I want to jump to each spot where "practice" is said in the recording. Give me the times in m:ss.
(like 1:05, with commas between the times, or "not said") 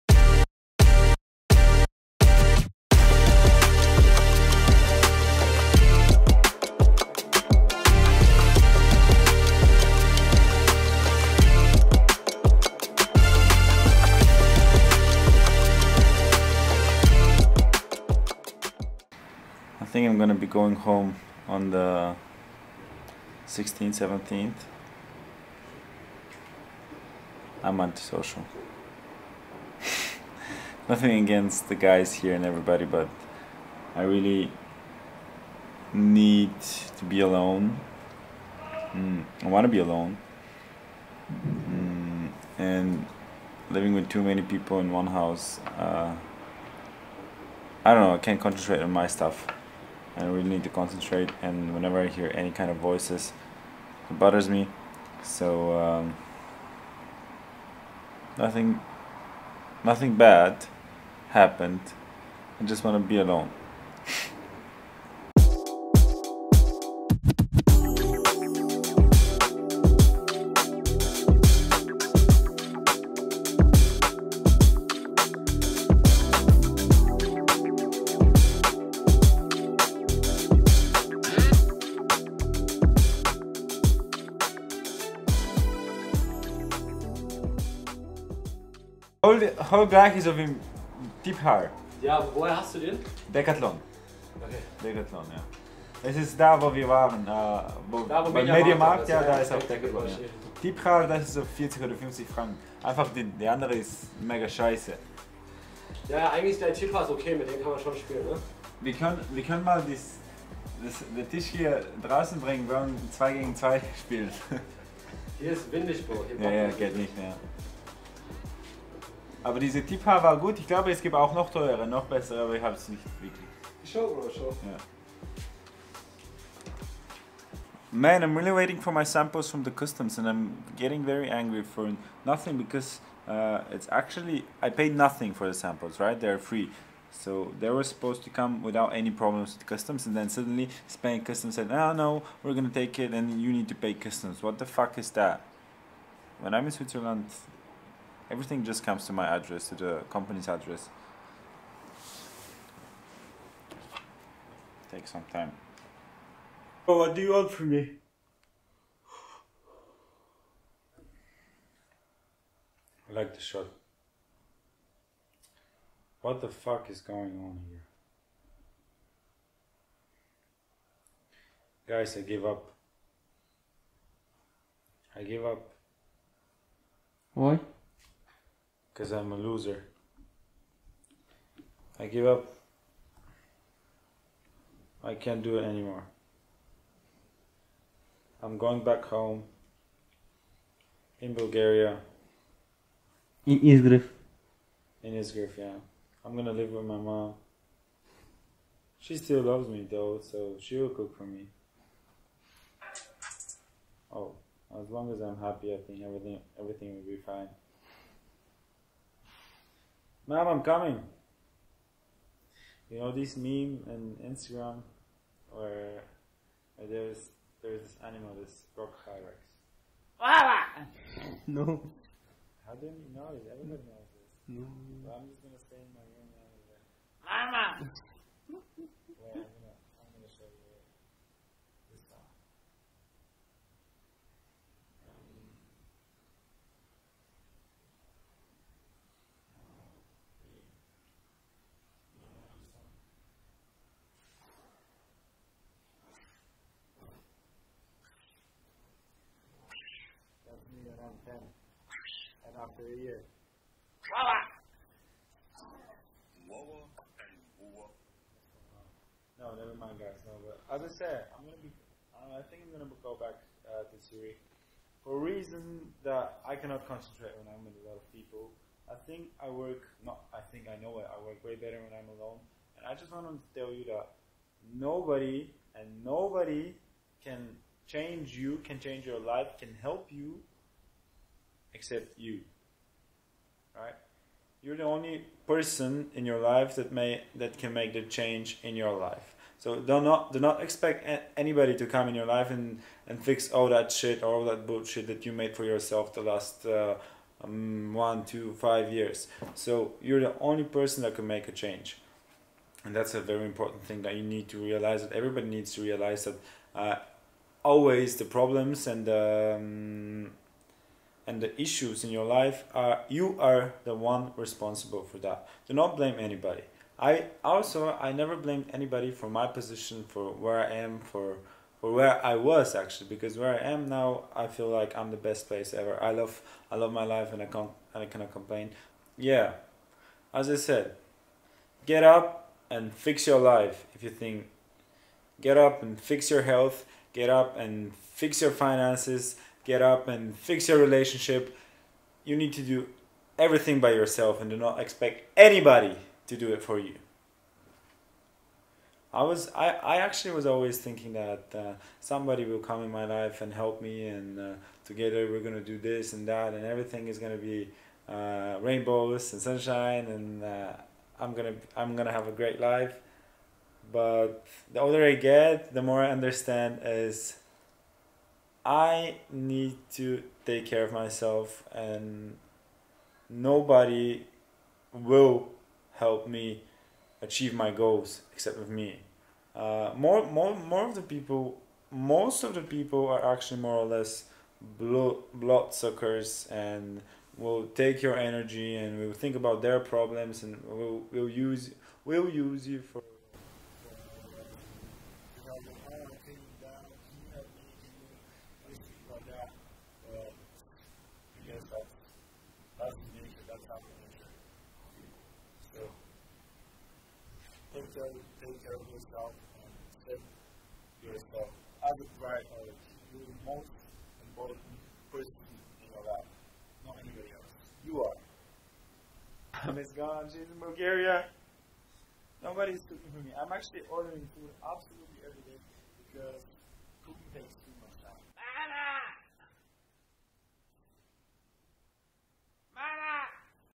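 not said.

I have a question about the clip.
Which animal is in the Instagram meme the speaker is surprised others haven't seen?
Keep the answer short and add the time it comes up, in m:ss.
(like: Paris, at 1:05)
rock hyrax, at 3:38.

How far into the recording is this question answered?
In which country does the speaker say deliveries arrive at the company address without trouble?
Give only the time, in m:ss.
2:26.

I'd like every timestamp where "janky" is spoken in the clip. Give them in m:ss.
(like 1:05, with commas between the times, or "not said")
not said.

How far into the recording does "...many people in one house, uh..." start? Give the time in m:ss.
0:44.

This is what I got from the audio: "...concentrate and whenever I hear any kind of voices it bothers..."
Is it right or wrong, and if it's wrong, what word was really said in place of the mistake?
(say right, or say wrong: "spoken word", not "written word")
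right.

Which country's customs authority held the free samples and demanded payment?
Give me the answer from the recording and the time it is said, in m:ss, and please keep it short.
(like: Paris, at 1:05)
Spain, at 2:20.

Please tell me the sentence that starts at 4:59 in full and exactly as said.
So you're the only person that can make a change, and that's a very important thing that you need to realize.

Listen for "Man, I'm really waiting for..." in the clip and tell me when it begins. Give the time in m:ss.
2:07.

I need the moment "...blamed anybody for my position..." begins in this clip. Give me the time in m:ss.
5:18.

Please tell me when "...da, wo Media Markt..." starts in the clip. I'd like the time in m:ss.
1:38.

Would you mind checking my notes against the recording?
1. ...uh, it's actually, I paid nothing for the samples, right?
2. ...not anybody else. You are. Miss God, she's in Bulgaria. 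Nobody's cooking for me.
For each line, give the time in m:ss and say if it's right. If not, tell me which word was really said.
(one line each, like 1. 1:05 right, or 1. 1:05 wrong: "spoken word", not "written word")
1. 2:13 right
2. 6:56 right.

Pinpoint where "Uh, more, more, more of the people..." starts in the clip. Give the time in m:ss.
6:19.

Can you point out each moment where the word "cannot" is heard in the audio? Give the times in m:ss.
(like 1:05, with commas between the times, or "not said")
4:26, 5:28.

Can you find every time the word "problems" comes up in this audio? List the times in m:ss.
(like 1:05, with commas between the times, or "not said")
2:19, 5:08, 6:29.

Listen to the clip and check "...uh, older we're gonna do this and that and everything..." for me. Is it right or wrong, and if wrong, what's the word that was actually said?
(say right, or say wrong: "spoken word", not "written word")
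wrong: "together", not "older".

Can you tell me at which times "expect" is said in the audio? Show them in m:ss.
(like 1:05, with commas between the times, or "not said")
4:50, 5:44.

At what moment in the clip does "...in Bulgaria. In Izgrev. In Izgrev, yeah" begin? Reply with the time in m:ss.
3:11.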